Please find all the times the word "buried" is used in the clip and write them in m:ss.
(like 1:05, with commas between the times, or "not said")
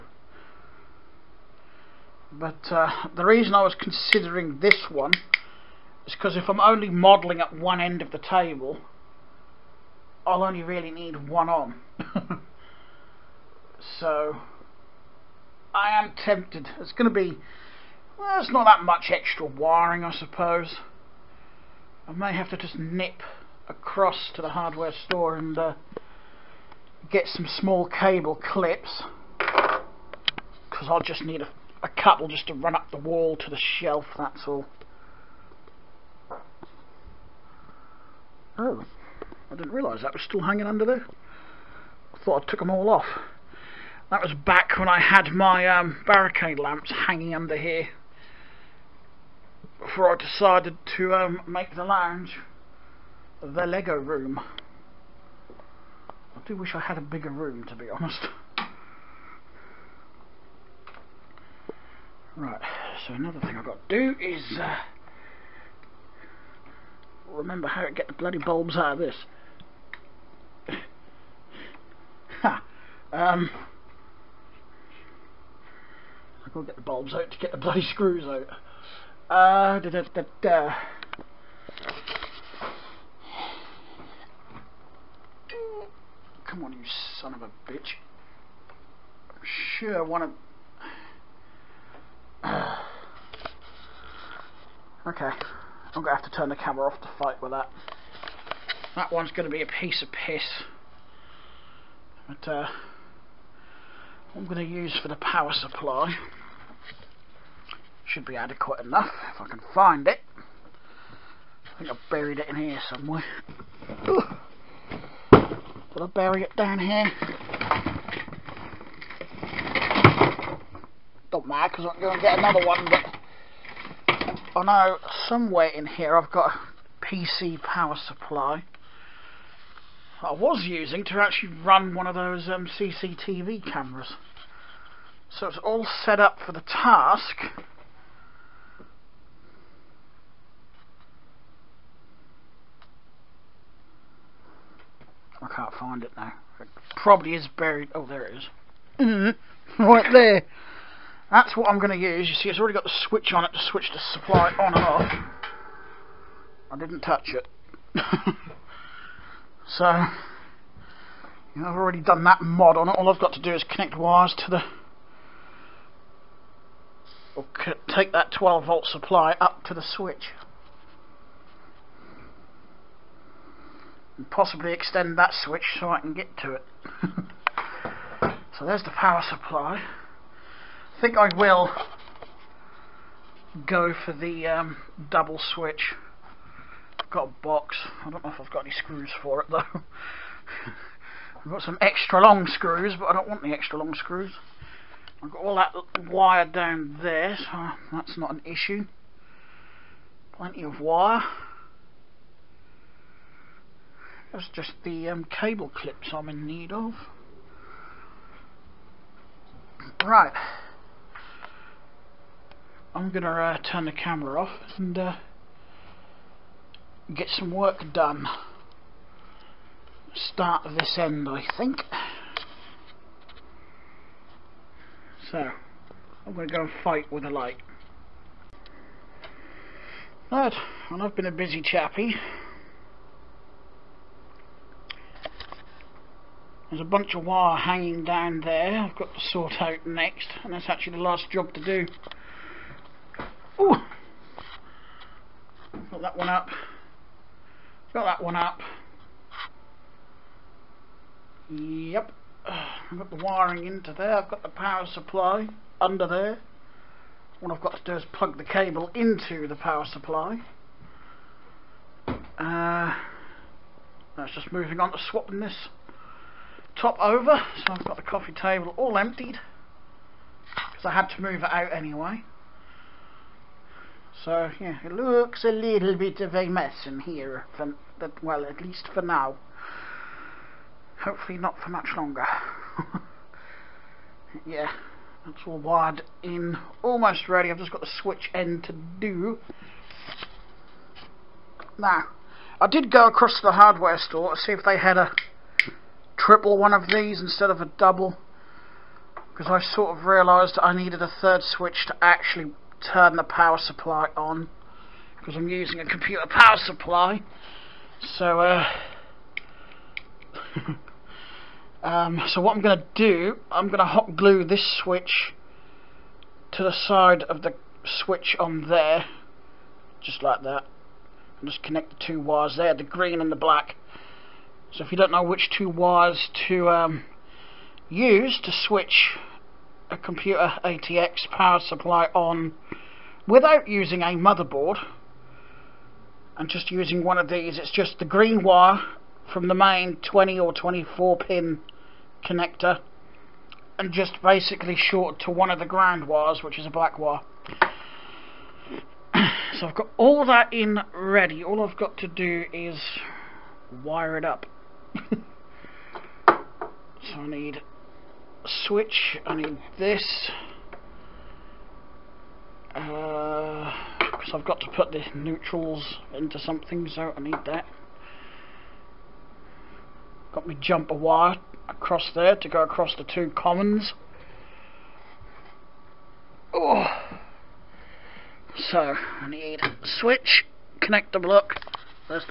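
1:52, 2:27.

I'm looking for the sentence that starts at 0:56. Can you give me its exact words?
I do wish I had a bigger room, to be honest.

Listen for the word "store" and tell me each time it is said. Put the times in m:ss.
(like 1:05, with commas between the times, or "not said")
0:25, 4:53.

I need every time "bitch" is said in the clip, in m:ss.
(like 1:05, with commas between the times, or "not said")
1:27.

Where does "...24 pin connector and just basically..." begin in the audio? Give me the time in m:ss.
5:40.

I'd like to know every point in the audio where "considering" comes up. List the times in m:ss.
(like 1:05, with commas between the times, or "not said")
0:03.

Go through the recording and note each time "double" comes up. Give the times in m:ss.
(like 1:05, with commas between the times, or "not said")
3:05, 4:57.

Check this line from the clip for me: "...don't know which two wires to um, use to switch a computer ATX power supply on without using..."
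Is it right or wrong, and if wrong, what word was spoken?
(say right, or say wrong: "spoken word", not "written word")
right.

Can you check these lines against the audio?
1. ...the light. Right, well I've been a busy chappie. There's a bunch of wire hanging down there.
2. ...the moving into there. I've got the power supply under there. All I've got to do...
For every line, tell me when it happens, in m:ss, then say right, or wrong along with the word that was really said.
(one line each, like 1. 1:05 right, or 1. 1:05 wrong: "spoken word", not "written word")
1. 3:47 right
2. 4:13 wrong: "wiring", not "moving".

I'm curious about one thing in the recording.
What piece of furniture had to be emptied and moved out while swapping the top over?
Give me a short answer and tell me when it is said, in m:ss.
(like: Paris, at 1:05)
coffee table, at 4:28.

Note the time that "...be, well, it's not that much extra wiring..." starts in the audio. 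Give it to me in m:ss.
0:17.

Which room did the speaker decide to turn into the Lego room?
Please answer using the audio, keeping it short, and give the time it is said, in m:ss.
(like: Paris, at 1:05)
the lounge, at 0:51.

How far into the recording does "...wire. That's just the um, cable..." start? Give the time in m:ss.
3:20.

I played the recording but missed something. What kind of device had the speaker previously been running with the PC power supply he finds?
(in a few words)
CCTV cameras.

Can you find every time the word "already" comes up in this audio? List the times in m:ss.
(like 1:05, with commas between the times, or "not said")
2:32, 2:41.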